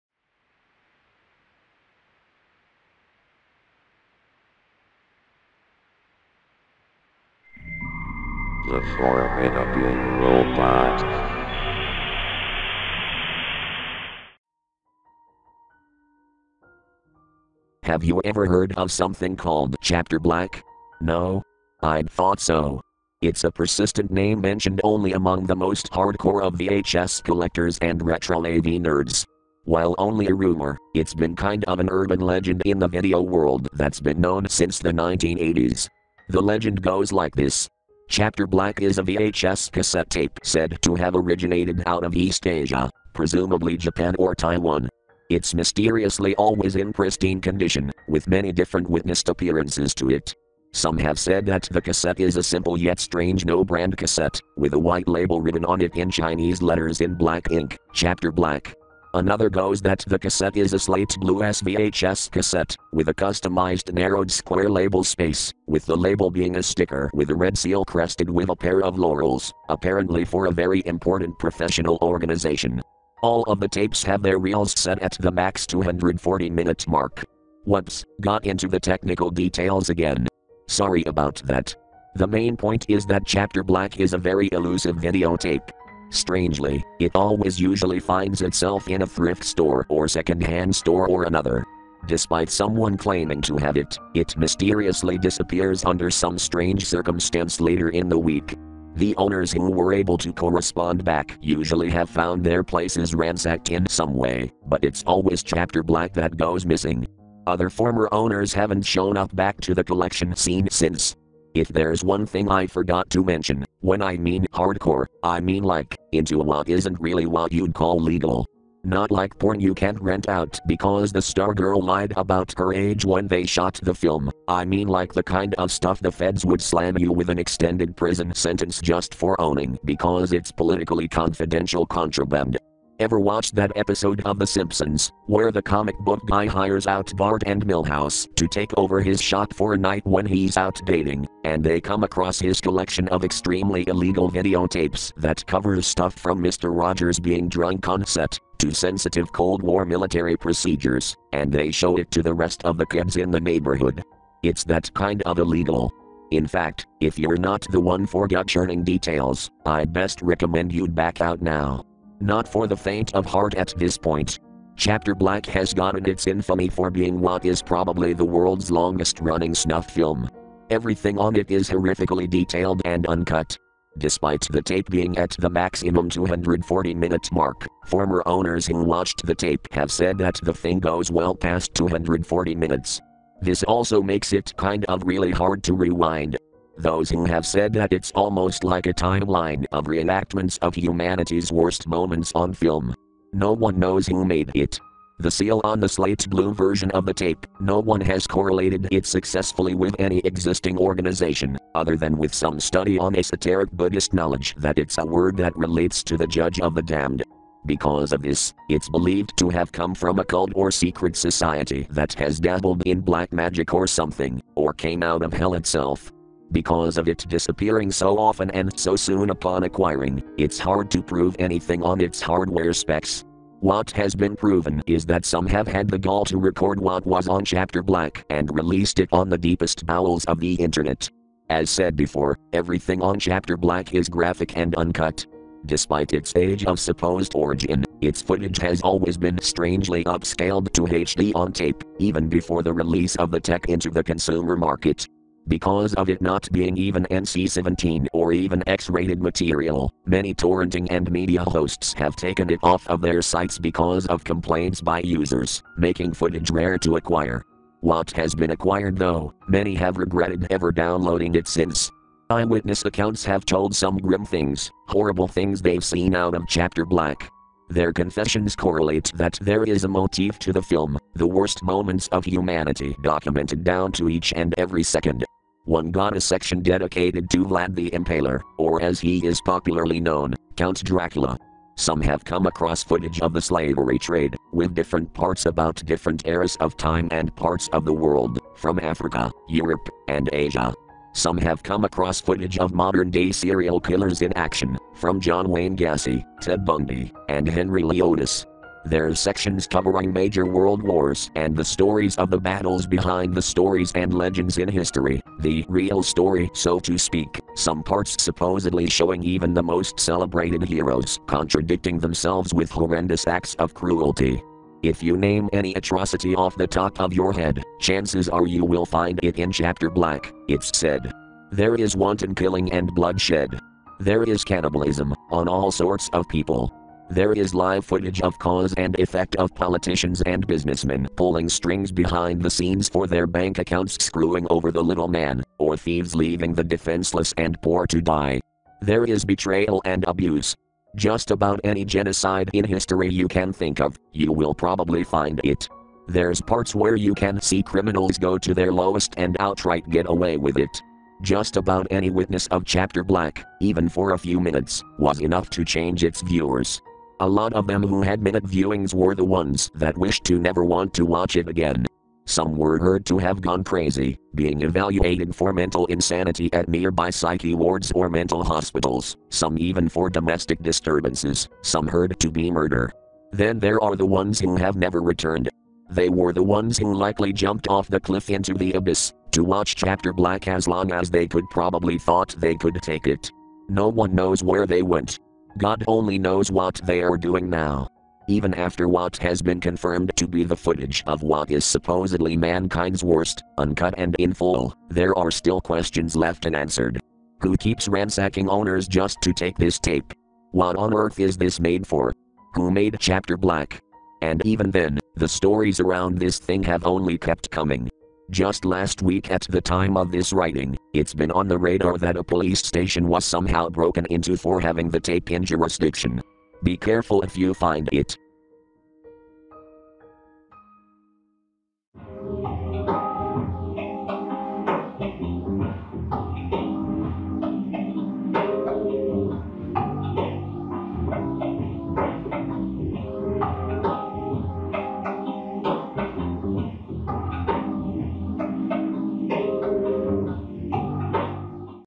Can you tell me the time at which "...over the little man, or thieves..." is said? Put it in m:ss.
5:34.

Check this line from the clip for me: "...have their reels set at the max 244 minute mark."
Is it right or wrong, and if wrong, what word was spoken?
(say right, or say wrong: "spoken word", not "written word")
wrong: "240", not "244".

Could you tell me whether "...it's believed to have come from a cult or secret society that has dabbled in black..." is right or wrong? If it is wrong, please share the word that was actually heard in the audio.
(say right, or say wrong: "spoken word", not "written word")
right.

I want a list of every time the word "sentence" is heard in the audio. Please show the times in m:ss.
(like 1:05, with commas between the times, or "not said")
2:08.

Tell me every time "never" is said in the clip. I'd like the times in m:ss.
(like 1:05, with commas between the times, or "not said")
6:00, 6:14.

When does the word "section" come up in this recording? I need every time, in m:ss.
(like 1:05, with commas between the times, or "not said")
4:36, 4:59.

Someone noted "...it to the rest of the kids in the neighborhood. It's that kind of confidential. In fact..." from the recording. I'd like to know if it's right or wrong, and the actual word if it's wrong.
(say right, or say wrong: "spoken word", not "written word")
wrong: "illegal", not "confidential".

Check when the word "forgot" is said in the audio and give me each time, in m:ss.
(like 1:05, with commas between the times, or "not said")
1:52.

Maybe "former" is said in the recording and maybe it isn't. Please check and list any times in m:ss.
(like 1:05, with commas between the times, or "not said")
1:47, 2:57.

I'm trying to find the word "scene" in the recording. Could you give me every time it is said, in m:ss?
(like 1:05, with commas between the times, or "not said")
1:50, 5:32.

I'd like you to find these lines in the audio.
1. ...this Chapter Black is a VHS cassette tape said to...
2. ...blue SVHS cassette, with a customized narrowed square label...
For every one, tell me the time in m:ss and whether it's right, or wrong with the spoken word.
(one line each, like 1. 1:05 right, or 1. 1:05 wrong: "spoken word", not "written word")
1. 0:37 right
2. 1:01 right.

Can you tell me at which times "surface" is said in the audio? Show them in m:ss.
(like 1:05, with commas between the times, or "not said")
not said.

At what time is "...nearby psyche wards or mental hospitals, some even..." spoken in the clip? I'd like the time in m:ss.
6:06.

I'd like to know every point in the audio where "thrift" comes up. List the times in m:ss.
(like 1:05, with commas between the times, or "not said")
1:29.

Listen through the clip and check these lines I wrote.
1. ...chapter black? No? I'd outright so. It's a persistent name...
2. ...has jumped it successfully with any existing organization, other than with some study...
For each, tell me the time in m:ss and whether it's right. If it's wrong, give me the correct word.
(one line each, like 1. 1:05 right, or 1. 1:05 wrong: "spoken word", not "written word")
1. 0:19 wrong: "thought", not "outright"
2. 3:18 wrong: "correlated", not "jumped".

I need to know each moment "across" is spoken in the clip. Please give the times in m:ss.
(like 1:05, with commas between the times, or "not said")
2:22, 4:42, 4:51.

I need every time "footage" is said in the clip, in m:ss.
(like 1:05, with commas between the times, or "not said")
3:58, 4:16, 4:42, 4:52, 5:27, 6:30.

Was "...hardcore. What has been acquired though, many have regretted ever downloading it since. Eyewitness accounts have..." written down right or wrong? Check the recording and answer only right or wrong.
wrong.